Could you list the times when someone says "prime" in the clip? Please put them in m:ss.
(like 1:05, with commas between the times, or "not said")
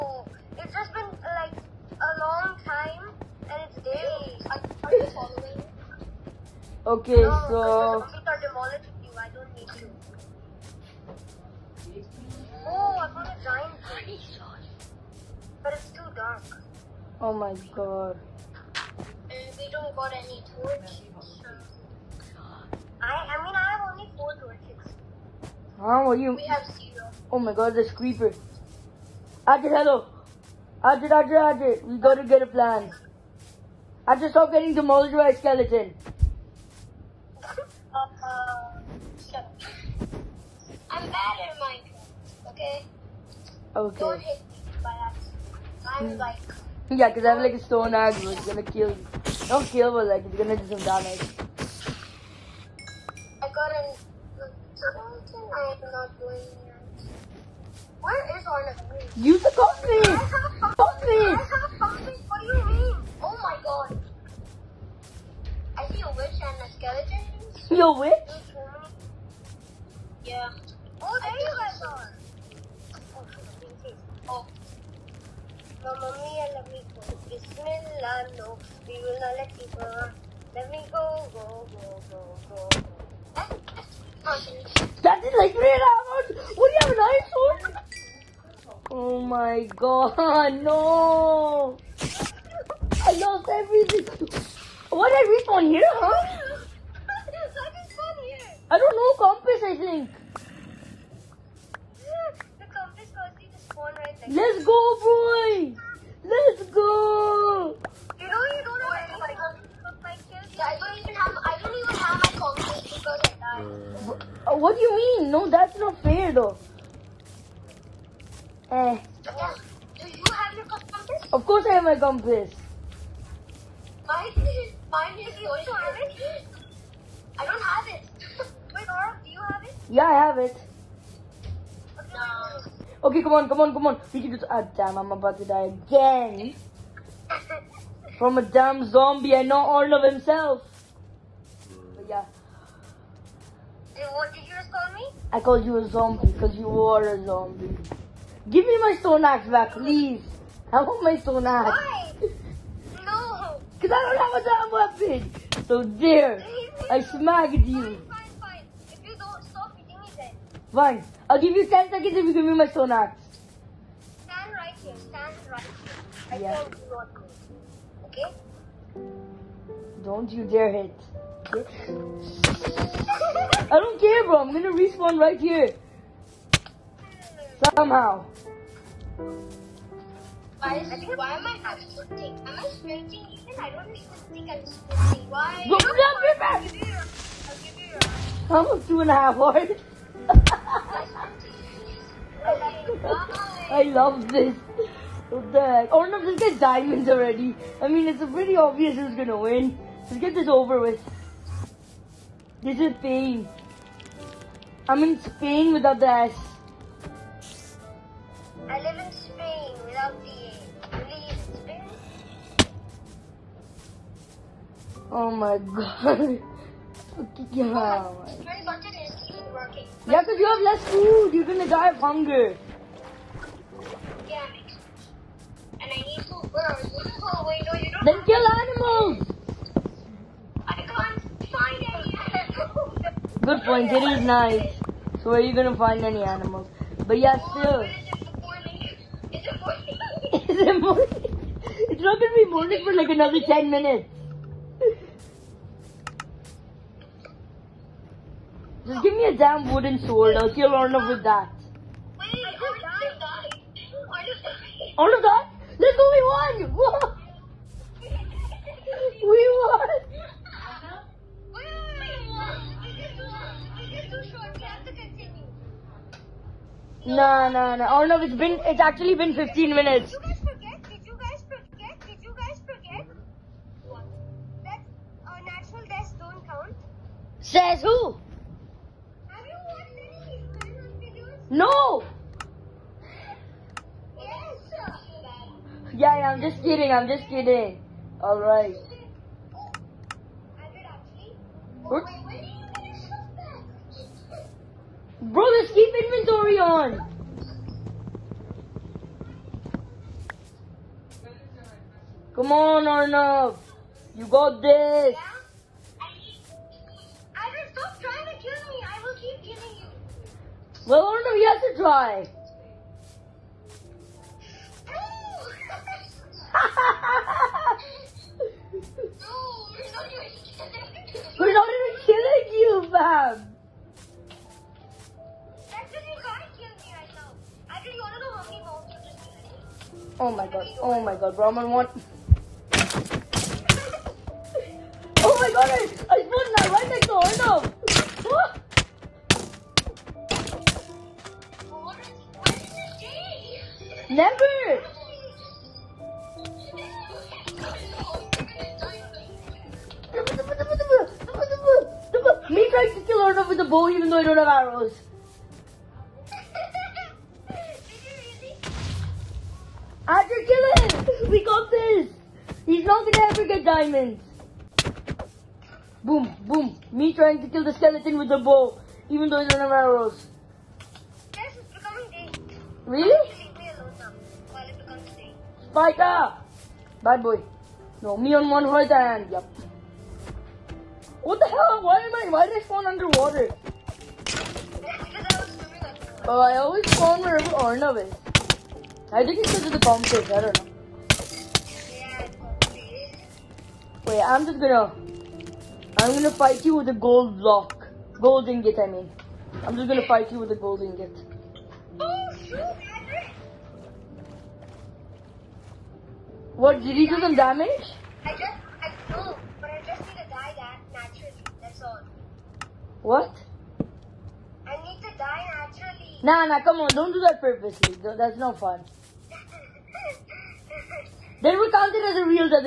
not said.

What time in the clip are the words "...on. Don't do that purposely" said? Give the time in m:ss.
6:56.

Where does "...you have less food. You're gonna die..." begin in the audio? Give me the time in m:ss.
3:40.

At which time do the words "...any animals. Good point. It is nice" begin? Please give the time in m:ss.
3:51.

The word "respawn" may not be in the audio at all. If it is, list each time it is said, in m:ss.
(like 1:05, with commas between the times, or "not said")
1:35, 2:54.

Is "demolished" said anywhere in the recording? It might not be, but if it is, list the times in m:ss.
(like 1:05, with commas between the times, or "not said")
0:08, 0:34.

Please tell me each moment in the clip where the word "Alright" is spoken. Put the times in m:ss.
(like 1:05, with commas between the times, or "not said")
4:48.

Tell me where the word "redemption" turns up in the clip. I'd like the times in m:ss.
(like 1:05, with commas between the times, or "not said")
not said.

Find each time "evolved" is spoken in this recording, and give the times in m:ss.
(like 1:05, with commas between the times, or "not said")
not said.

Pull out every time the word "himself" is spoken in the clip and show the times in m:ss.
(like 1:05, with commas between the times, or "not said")
2:20.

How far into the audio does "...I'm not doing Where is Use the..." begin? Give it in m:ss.
0:55.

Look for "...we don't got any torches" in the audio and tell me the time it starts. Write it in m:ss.
0:19.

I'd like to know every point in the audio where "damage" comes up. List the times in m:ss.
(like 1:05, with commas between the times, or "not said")
0:50, 6:47.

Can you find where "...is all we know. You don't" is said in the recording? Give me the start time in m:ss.
3:47.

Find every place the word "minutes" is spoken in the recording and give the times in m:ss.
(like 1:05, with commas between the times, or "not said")
4:03.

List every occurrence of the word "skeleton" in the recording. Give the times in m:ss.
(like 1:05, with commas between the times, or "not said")
0:35, 6:07.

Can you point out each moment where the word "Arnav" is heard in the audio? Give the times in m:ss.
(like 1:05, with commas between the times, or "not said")
5:02, 5:11, 6:27.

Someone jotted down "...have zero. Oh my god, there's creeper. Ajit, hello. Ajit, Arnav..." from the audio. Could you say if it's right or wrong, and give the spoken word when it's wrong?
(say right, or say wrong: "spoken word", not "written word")
wrong: "Ajit", not "Arnav".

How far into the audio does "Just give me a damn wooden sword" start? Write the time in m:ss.
4:08.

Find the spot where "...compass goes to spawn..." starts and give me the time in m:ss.
1:42.